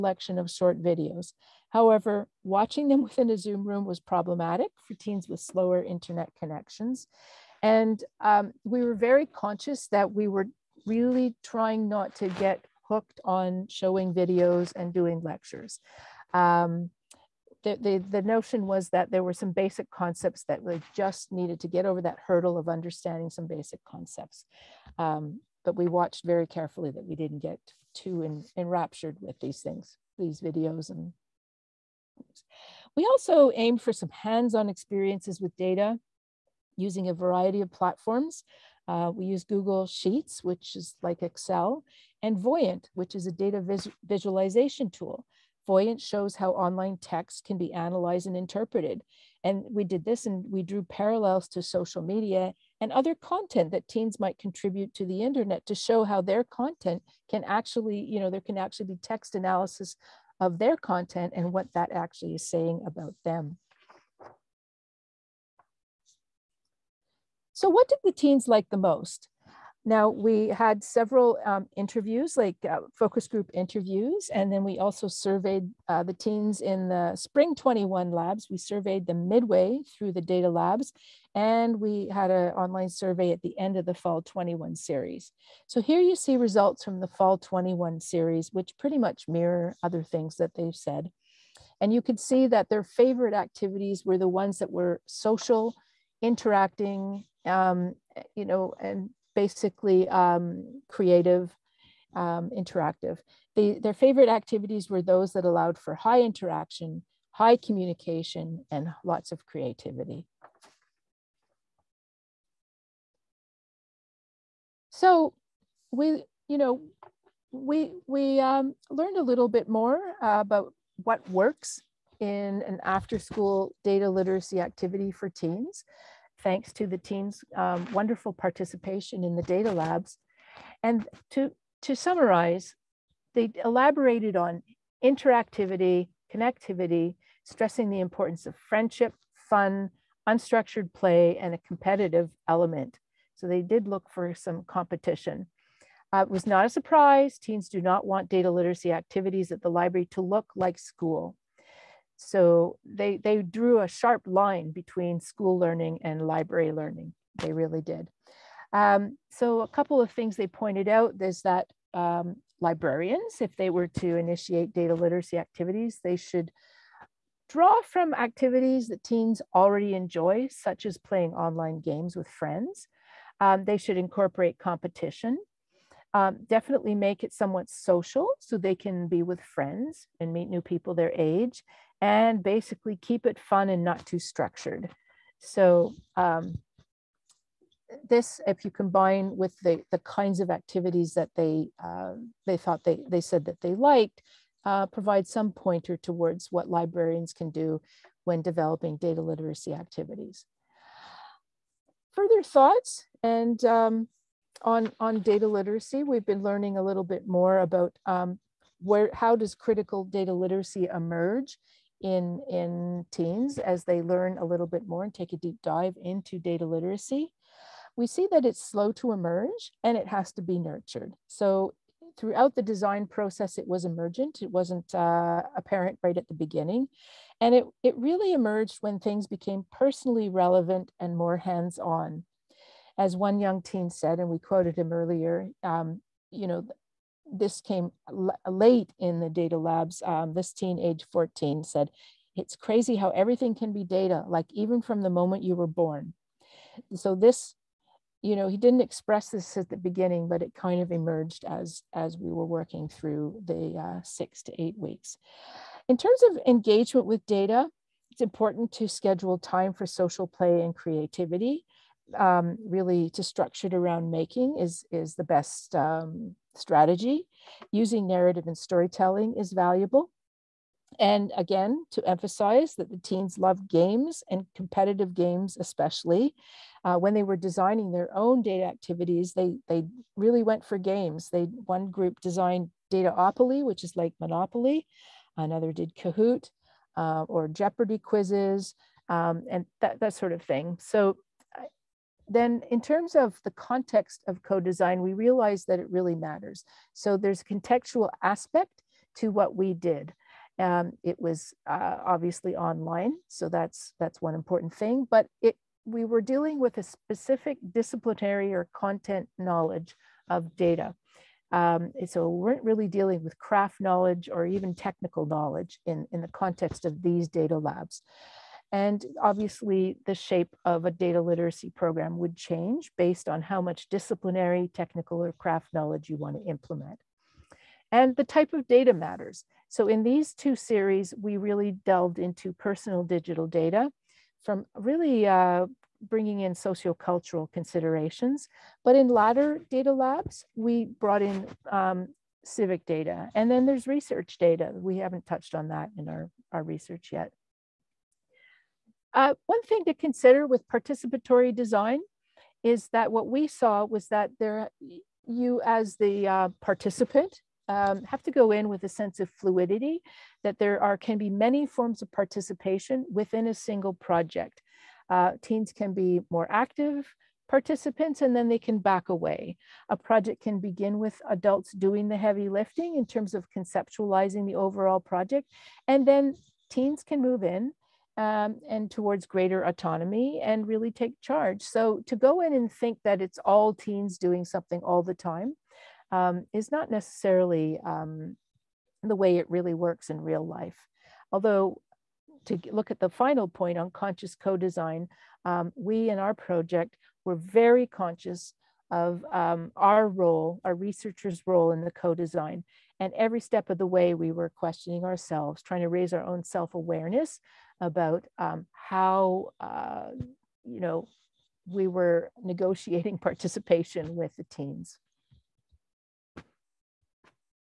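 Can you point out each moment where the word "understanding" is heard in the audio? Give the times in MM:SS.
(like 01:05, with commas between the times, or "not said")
00:22.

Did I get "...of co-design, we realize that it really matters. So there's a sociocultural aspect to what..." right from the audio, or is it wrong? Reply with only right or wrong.
wrong.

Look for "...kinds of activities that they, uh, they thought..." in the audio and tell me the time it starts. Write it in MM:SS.
03:09.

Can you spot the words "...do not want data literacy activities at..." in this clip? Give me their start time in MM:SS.
02:27.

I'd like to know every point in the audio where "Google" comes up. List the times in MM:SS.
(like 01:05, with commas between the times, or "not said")
00:39.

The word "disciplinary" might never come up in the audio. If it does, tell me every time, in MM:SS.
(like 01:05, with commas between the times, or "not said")
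05:07, 05:23.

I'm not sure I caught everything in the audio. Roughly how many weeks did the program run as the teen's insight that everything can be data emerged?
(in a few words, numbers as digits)
6 to 8 weeks.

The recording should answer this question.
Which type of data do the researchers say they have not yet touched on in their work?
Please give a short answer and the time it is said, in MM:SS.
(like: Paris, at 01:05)
Research data, at 05:43.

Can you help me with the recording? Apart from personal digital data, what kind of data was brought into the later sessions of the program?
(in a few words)
Civic data.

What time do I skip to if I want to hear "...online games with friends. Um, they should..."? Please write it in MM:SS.
02:51.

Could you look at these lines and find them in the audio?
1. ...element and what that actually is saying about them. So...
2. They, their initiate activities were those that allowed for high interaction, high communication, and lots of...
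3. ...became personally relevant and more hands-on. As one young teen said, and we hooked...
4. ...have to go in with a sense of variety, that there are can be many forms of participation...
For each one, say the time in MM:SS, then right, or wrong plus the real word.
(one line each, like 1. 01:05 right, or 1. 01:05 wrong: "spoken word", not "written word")
1. 01:00 wrong: "content", not "element"
2. 01:43 wrong: "favorite", not "initiate"
3. 03:49 wrong: "quoted", not "hooked"
4. 05:58 wrong: "fluidity", not "variety".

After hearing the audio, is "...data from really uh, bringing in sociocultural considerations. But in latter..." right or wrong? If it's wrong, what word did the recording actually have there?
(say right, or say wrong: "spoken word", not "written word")
right.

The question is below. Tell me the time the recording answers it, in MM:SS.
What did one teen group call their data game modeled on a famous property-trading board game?
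04:42.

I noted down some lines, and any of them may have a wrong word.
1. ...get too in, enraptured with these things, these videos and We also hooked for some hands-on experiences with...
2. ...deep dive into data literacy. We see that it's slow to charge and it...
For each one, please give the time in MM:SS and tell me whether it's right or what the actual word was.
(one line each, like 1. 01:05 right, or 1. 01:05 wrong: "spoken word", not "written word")
1. 00:27 wrong: "aimed", not "hooked"
2. 03:35 wrong: "emerge", not "charge".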